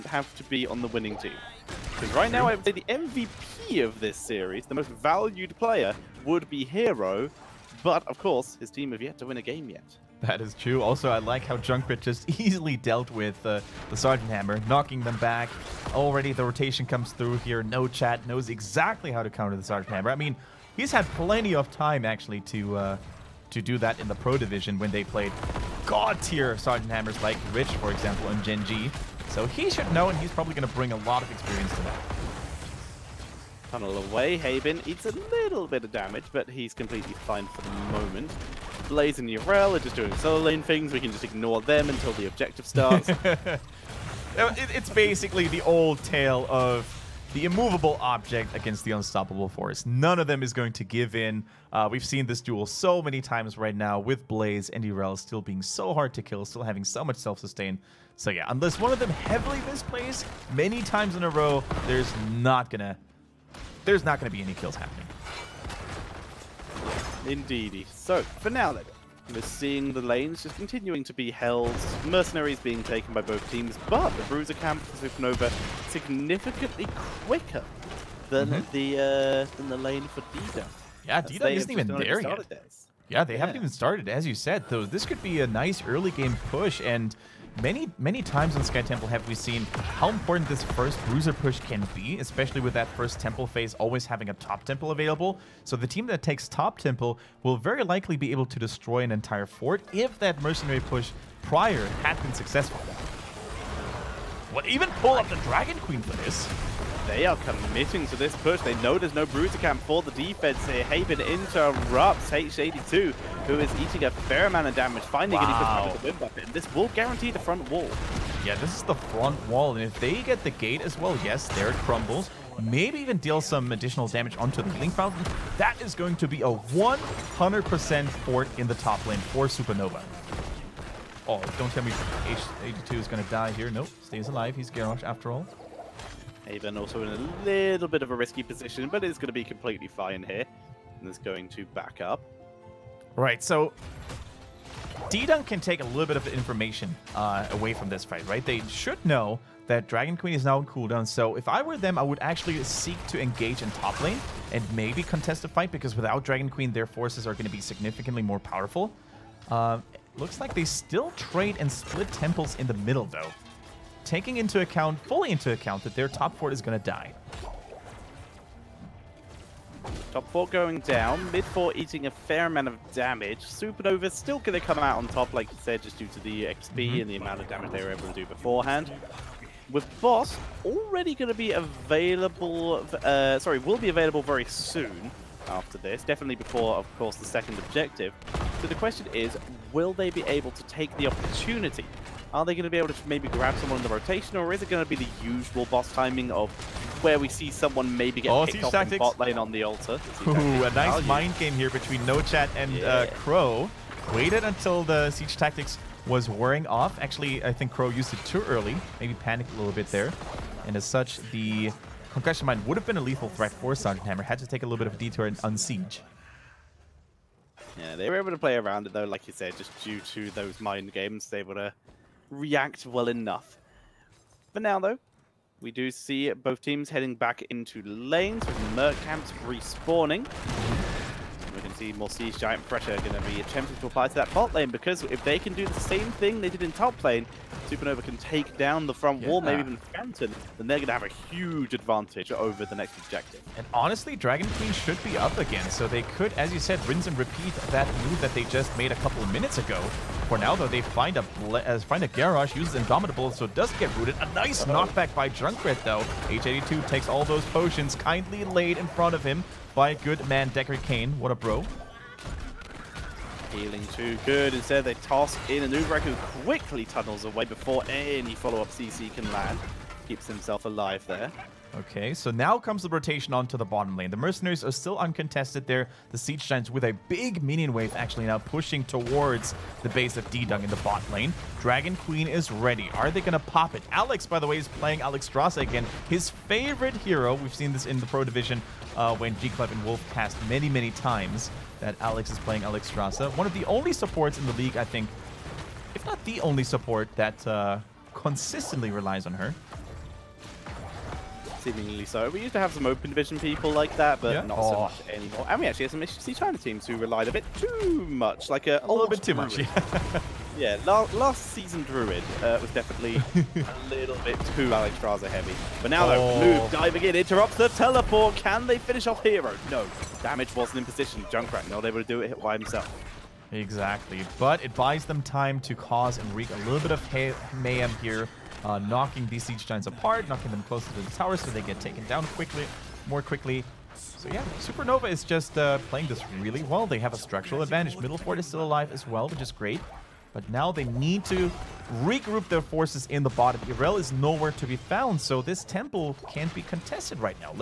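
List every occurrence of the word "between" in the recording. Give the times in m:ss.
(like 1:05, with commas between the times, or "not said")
3:21.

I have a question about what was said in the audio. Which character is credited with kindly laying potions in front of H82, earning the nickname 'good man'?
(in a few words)
Deckard Cain.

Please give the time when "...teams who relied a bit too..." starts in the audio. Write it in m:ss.
5:06.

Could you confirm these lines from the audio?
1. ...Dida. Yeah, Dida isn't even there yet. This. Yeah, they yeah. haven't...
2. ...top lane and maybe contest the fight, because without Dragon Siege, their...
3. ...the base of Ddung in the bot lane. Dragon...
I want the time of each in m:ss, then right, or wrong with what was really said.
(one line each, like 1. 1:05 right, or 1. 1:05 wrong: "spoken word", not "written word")
1. 1:20 right
2. 2:33 wrong: "Queen", not "Siege"
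3. 4:39 right.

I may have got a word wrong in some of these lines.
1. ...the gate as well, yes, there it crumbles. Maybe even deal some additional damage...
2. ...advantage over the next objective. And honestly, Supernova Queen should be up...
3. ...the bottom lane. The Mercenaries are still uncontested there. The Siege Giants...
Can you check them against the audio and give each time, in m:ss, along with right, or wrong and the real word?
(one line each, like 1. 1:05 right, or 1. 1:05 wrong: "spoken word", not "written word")
1. 2:00 right
2. 4:01 wrong: "Dragon", not "Supernova"
3. 4:33 right.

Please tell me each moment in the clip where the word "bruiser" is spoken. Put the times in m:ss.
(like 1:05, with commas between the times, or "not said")
1:14, 1:31, 1:49.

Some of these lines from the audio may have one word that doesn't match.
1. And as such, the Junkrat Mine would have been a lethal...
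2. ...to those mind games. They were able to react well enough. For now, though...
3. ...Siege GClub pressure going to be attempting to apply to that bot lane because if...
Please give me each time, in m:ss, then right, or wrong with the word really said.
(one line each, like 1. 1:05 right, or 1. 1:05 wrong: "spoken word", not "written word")
1. 3:30 wrong: "Concussion", not "Junkrat"
2. 3:40 right
3. 3:52 wrong: "Giant", not "GClub".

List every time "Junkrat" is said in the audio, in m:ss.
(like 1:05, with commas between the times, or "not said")
0:11, 4:15, 5:21.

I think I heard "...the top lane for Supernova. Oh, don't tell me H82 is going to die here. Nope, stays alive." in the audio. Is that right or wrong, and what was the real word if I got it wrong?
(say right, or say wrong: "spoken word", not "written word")
right.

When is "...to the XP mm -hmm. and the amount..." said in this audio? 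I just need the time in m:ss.
2:56.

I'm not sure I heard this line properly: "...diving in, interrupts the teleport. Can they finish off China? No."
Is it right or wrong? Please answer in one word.
wrong.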